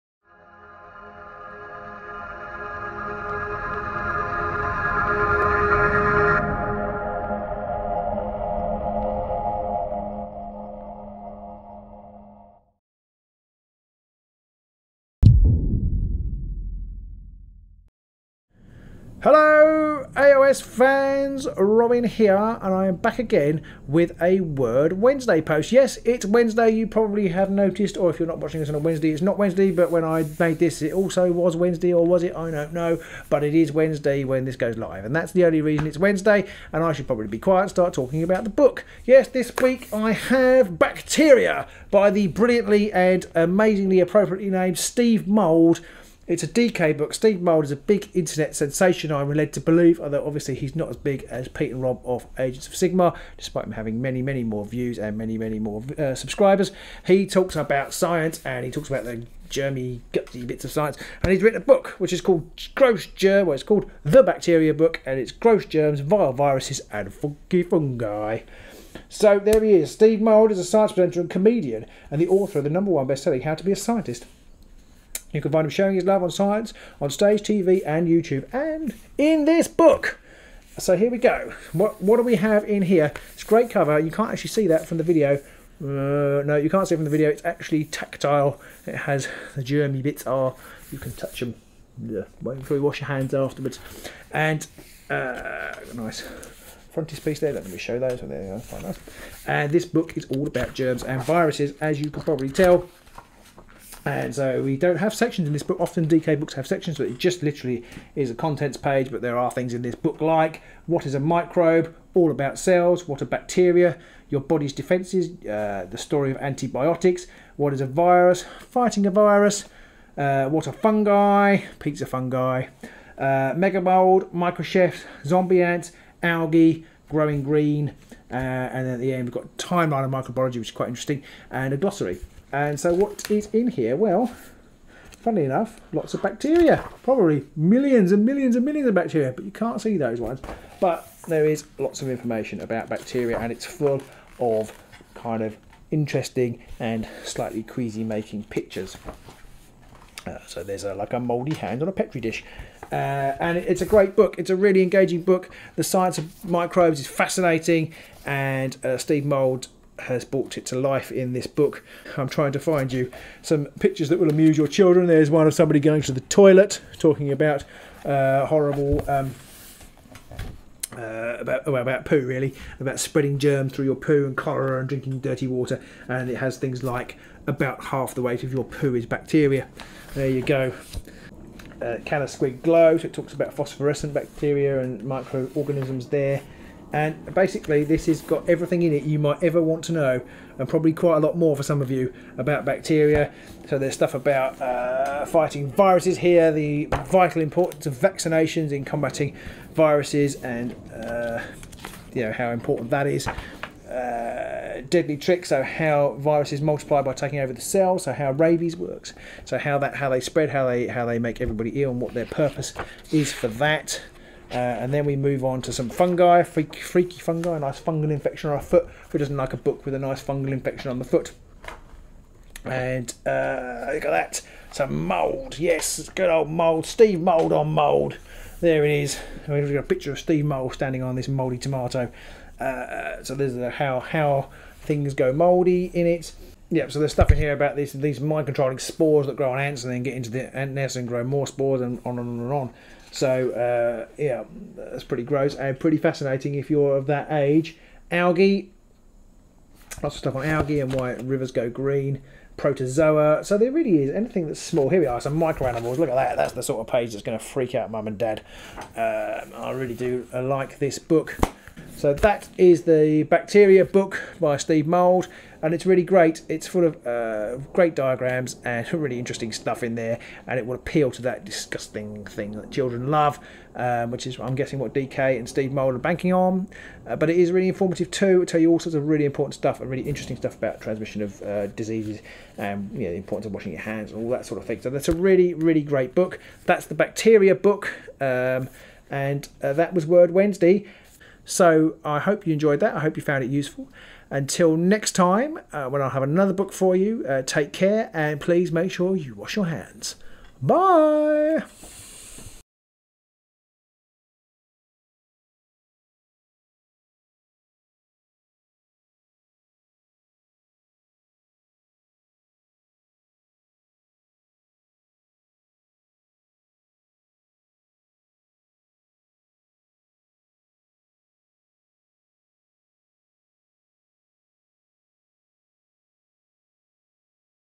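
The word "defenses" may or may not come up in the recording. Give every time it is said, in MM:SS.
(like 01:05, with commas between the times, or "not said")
01:54.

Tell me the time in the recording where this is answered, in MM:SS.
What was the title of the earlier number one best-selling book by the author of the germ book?
01:13.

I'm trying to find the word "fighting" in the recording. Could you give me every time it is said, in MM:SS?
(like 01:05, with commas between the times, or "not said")
01:58, 03:15.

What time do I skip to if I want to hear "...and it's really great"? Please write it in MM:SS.
04:25.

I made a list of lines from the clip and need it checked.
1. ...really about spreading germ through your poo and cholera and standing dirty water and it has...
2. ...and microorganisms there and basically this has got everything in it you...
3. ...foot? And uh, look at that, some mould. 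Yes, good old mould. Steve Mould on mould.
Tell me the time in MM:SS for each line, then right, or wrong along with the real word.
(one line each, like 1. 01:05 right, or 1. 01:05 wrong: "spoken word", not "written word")
1. 02:52 wrong: "drinking", not "standing"
2. 03:04 right
3. 03:41 right.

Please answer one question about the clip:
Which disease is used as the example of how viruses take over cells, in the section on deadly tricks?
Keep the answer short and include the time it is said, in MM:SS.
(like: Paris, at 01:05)
Rabies, at 03:28.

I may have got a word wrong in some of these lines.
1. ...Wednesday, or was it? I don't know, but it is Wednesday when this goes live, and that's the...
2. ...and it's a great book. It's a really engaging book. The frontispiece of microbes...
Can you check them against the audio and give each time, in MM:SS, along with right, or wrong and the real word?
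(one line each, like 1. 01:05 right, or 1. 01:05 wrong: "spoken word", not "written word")
1. 00:31 right
2. 02:33 wrong: "science", not "frontispiece".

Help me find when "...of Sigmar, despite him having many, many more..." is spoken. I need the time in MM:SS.
00:52.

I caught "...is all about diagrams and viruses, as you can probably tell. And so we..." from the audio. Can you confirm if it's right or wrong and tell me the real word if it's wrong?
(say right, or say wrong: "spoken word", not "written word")
wrong: "germs", not "diagrams".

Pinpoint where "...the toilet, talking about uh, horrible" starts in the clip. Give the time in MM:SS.
02:46.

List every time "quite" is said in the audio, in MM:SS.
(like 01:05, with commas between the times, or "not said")
02:10, 03:10.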